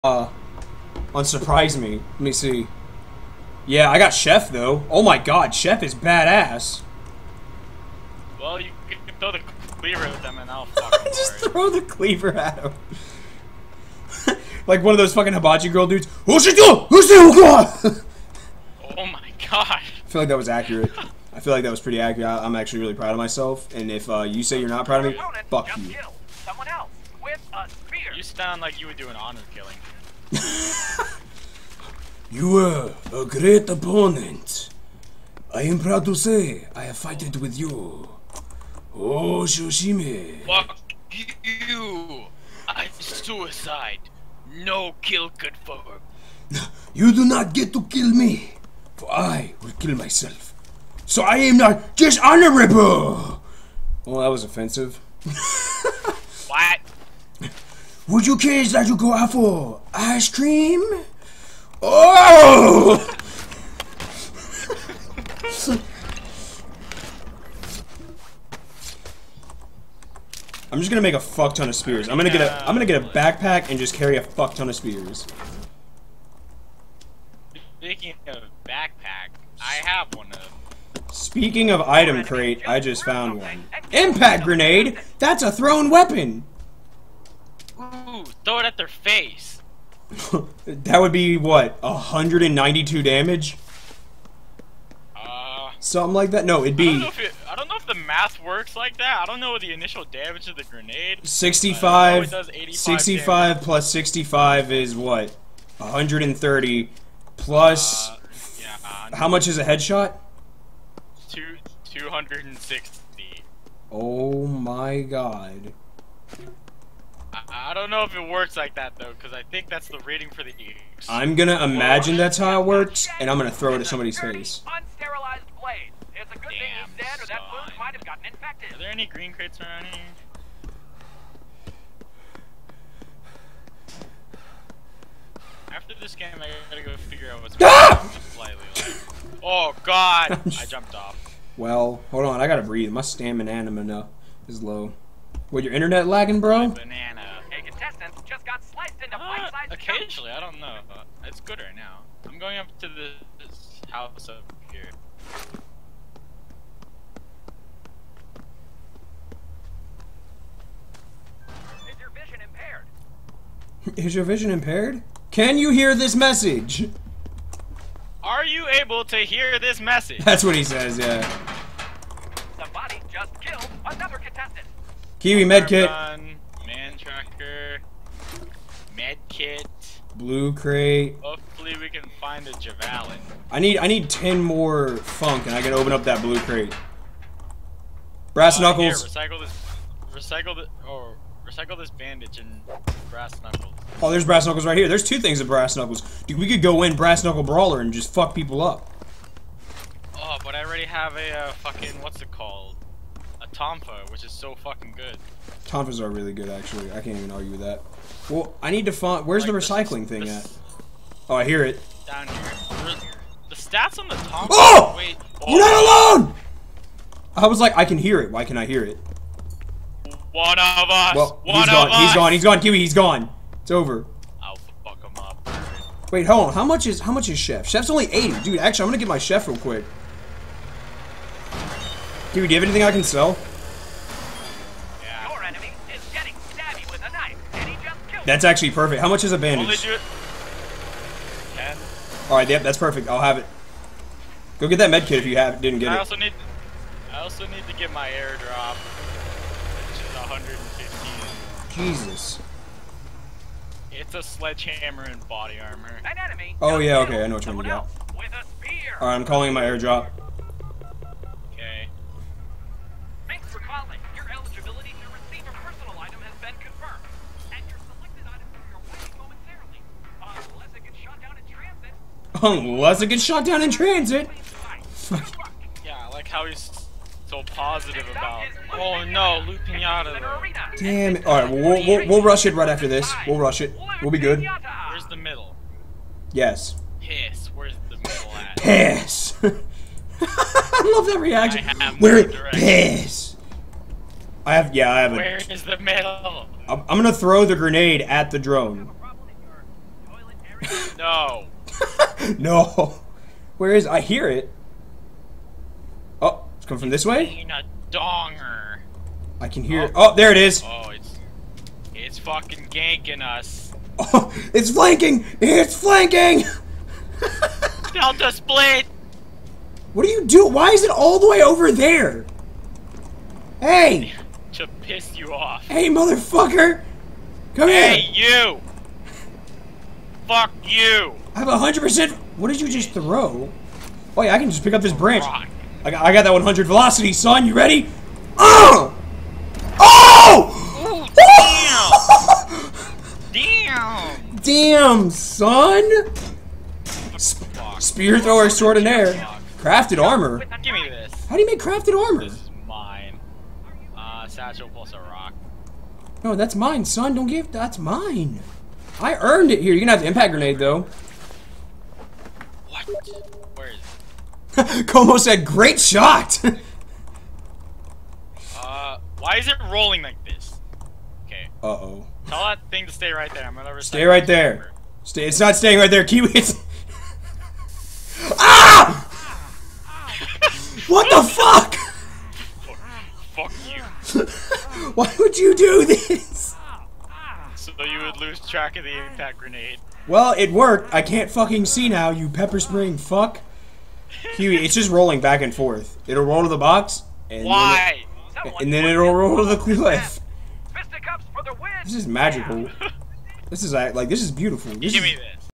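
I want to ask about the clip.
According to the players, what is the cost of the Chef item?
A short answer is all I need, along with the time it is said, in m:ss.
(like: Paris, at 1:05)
80, at 3:48.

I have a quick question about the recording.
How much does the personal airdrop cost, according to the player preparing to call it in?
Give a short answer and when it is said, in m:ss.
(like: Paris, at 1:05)
115, at 4:10.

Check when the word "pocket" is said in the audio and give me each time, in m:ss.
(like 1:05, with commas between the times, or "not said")
not said.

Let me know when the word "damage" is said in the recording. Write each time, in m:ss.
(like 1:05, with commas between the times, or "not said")
1:33, 1:40.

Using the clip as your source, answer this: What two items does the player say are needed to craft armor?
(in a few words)
satchel plus a rock.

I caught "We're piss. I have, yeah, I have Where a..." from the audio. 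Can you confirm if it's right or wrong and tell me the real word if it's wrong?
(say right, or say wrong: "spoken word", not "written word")
right.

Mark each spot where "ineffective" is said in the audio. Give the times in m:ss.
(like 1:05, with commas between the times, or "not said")
not said.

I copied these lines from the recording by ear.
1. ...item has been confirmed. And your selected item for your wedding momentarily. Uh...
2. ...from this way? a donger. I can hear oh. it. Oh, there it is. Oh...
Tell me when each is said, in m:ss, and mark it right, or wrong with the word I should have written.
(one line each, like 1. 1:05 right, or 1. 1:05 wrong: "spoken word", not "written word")
1. 4:26 right
2. 5:06 right.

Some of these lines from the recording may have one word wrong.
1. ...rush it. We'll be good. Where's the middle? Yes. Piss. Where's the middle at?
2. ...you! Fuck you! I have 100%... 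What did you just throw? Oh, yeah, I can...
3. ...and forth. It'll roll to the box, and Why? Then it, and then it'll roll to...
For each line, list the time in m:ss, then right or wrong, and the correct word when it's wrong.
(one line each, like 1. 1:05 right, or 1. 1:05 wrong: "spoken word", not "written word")
1. 4:43 right
2. 5:28 right
3. 6:35 right.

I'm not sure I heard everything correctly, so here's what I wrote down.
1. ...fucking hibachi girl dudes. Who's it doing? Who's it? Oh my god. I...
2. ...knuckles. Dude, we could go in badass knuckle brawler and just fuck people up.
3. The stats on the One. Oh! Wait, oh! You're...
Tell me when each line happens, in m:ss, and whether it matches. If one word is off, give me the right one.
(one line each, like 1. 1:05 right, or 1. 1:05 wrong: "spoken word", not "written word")
1. 0:15 right
2. 3:15 wrong: "brass", not "badass"
3. 3:33 wrong: "Tompa", not "One".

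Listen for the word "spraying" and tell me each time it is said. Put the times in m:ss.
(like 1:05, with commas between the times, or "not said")
6:32.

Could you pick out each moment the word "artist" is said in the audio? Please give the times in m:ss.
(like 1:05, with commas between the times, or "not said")
not said.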